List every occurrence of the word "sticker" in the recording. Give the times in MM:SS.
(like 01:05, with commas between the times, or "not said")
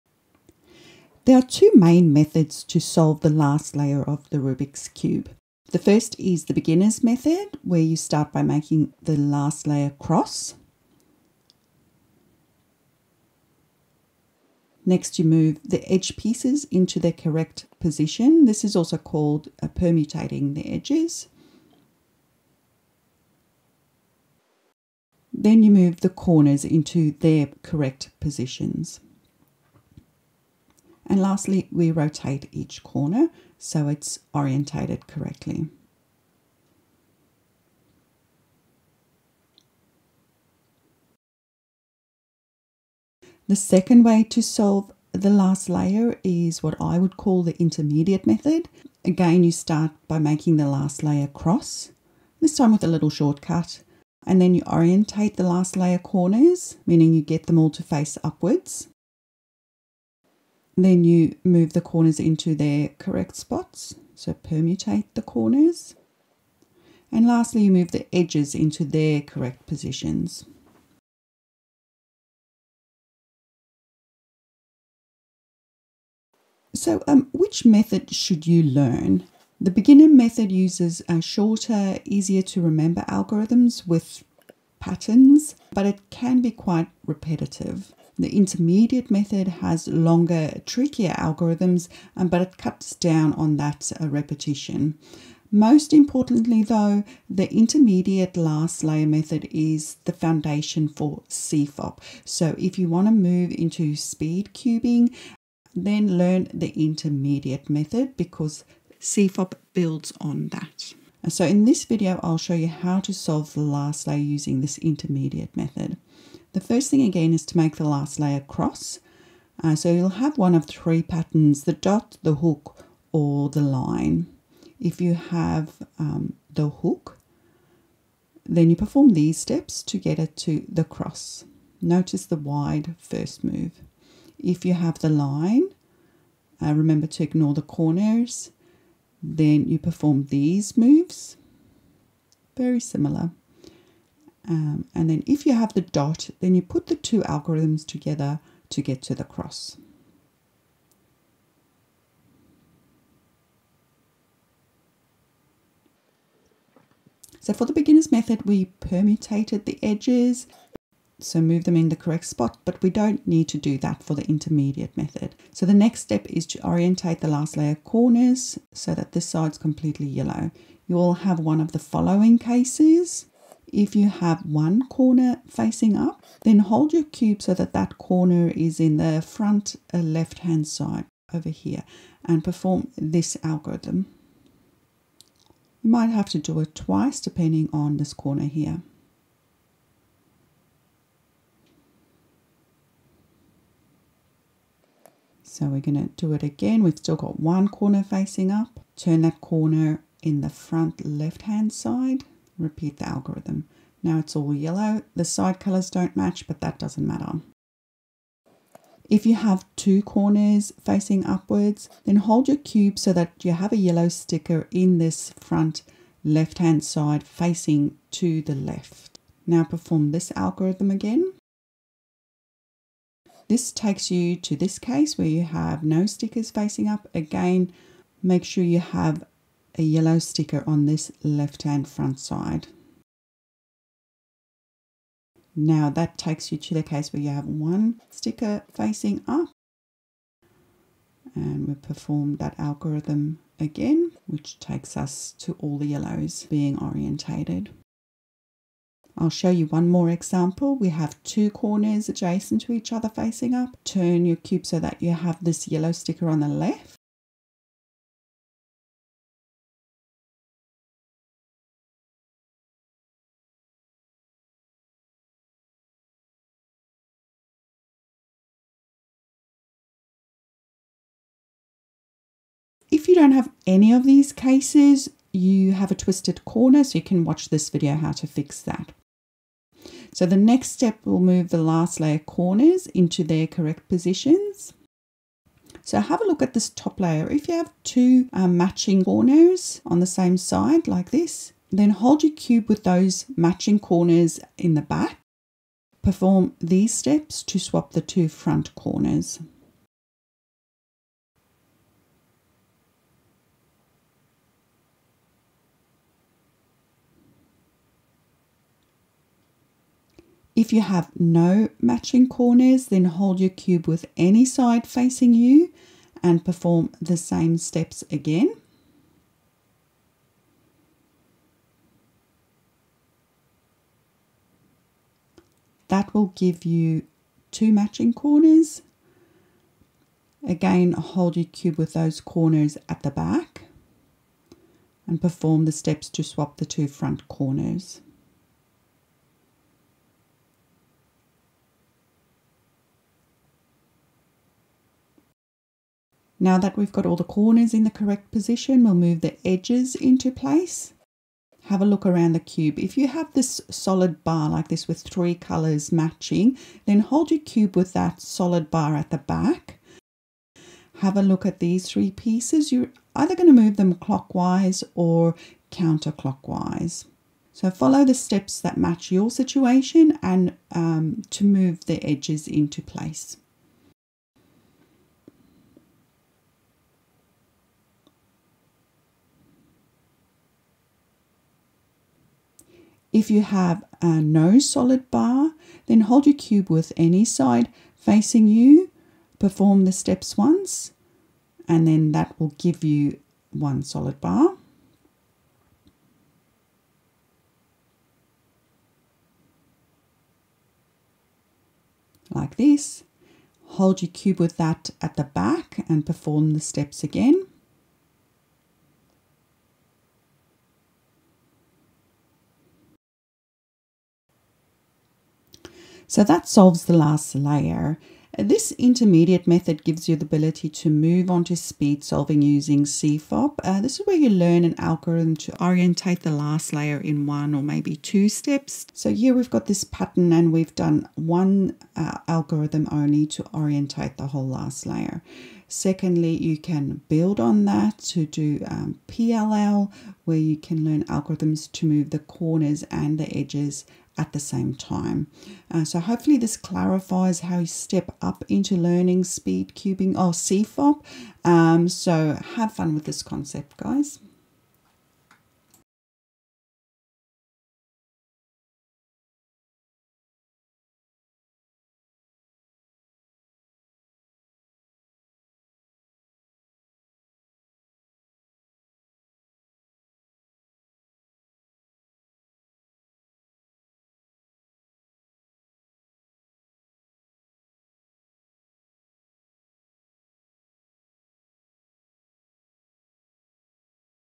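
03:34, 03:46, 03:50, 03:58, 04:15.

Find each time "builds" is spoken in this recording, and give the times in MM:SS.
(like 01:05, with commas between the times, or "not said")
01:49, 07:17.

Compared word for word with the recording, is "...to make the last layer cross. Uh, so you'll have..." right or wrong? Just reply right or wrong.
right.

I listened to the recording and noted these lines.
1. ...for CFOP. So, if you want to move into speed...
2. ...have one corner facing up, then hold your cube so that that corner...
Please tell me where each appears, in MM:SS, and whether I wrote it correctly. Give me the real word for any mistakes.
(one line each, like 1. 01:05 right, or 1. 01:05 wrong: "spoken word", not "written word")
1. 01:40 right
2. 02:54 right.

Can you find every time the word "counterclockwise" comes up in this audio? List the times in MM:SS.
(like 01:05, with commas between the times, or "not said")
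06:05.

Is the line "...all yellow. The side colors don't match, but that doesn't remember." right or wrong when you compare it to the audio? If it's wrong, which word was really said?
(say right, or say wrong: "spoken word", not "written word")
wrong: "matter", not "remember".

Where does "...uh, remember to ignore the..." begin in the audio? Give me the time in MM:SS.
02:16.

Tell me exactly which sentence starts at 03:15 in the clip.
So we're going to do it again.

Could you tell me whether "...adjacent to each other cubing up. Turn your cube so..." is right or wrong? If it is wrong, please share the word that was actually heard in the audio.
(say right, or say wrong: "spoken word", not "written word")
wrong: "facing", not "cubing".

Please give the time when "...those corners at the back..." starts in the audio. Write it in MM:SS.
05:31.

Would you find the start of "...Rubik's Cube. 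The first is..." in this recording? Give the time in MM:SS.
00:04.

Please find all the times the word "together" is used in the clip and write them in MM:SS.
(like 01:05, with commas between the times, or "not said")
02:27.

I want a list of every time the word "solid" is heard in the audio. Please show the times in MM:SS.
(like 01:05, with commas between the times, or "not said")
05:53, 05:58, 06:24, 06:33.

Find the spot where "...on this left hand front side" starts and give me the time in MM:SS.
03:50.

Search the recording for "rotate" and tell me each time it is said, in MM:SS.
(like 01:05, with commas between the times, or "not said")
00:31.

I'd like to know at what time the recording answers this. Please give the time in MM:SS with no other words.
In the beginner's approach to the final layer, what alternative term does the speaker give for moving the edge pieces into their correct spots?
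00:19.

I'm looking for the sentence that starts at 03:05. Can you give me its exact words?
You might have to do it twice depending on this corner here.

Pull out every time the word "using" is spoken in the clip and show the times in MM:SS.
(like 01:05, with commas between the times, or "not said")
01:54, 07:02.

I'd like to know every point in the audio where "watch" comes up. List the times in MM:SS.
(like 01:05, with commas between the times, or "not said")
04:37.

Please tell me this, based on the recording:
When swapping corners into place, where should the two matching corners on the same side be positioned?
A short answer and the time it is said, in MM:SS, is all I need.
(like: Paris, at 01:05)
in the back, at 04:54.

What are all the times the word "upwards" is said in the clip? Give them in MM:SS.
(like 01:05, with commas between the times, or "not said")
00:58, 03:31.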